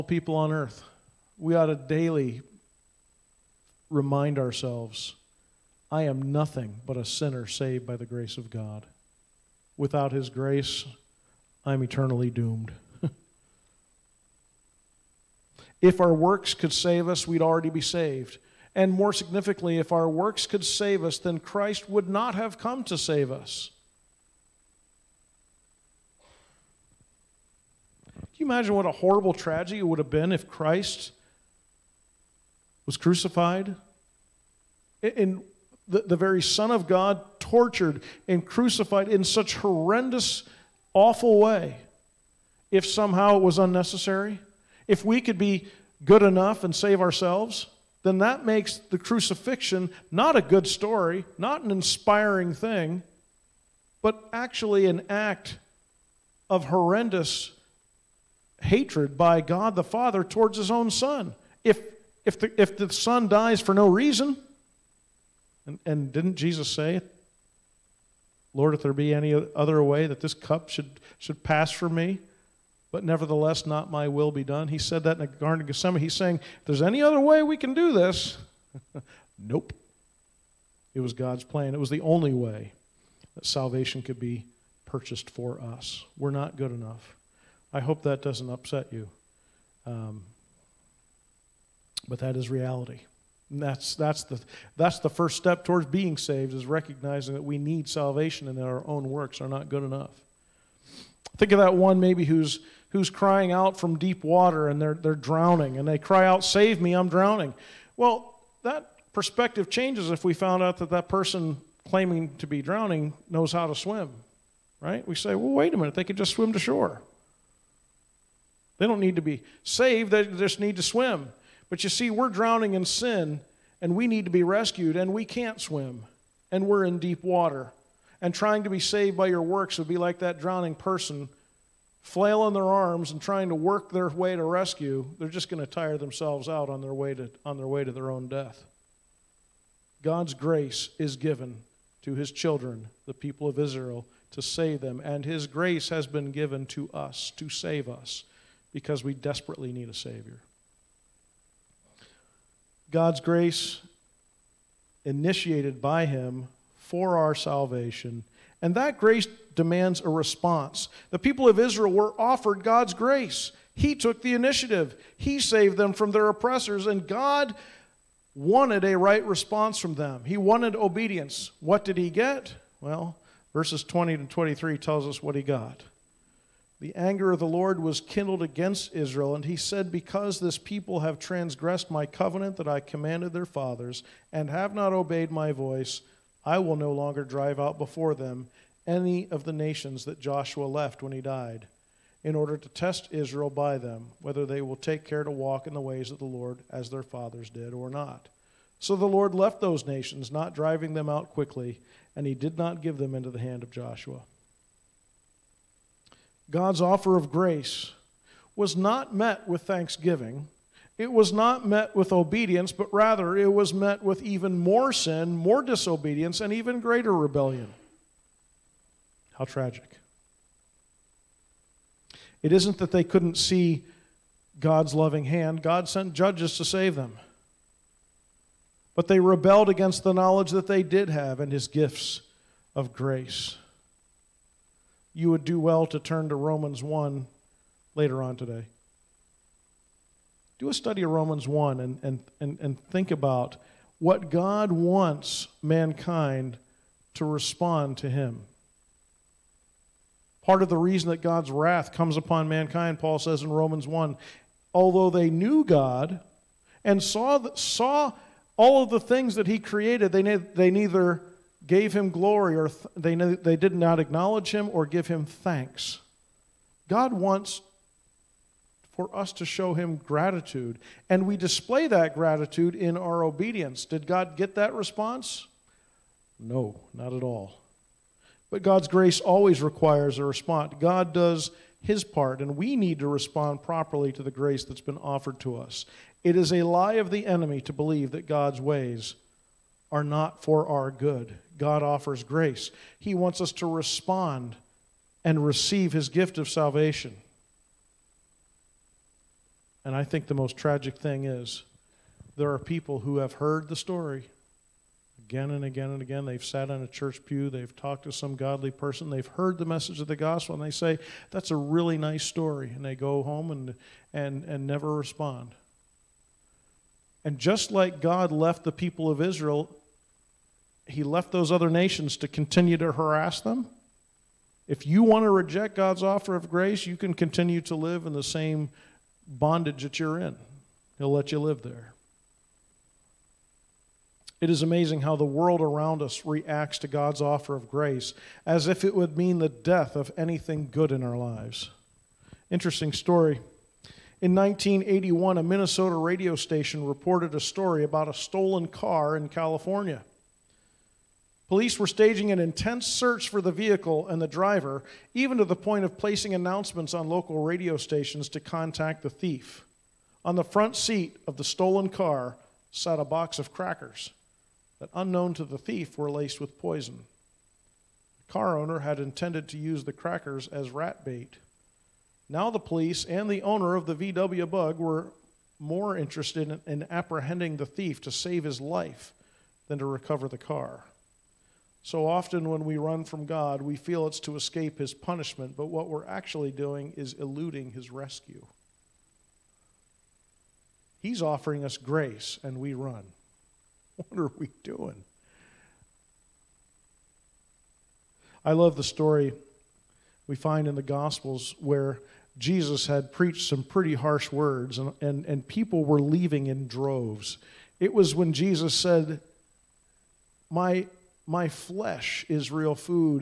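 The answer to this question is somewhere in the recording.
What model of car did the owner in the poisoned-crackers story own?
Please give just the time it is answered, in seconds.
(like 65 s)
374 s.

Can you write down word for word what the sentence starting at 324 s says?
If you want to reject God's offer of grace, you can continue to live in the same bondage that you're in.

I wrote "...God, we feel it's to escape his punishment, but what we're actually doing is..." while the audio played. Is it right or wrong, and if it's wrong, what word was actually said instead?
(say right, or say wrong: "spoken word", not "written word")
right.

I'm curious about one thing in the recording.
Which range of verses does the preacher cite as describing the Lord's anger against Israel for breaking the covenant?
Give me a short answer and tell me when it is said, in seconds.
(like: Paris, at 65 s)
20 to 23, at 173 s.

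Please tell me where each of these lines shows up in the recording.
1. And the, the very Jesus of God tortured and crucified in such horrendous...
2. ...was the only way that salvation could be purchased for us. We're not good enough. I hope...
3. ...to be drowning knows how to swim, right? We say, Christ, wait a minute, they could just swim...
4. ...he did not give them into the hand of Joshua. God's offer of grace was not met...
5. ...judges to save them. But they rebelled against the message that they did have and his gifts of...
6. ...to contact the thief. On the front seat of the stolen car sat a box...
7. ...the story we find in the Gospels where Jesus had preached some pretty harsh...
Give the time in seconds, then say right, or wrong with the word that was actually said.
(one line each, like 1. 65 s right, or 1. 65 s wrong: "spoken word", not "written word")
1. 35 s wrong: "Son", not "Jesus"
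2. 81 s right
3. 112 s wrong: "Well", not "Christ"
4. 202 s right
5. 226 s wrong: "knowledge", not "message"
6. 358 s right
7. 398 s right.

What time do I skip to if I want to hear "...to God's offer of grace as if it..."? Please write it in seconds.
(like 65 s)
336 s.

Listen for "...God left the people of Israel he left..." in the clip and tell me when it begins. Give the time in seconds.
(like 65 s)
317 s.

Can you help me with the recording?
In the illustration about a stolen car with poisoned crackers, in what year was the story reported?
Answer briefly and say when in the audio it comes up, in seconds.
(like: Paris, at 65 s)
1981, at 344 s.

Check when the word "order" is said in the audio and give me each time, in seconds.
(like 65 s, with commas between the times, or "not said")
192 s.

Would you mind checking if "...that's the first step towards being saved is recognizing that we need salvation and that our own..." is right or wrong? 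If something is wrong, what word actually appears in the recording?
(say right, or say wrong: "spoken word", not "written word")
right.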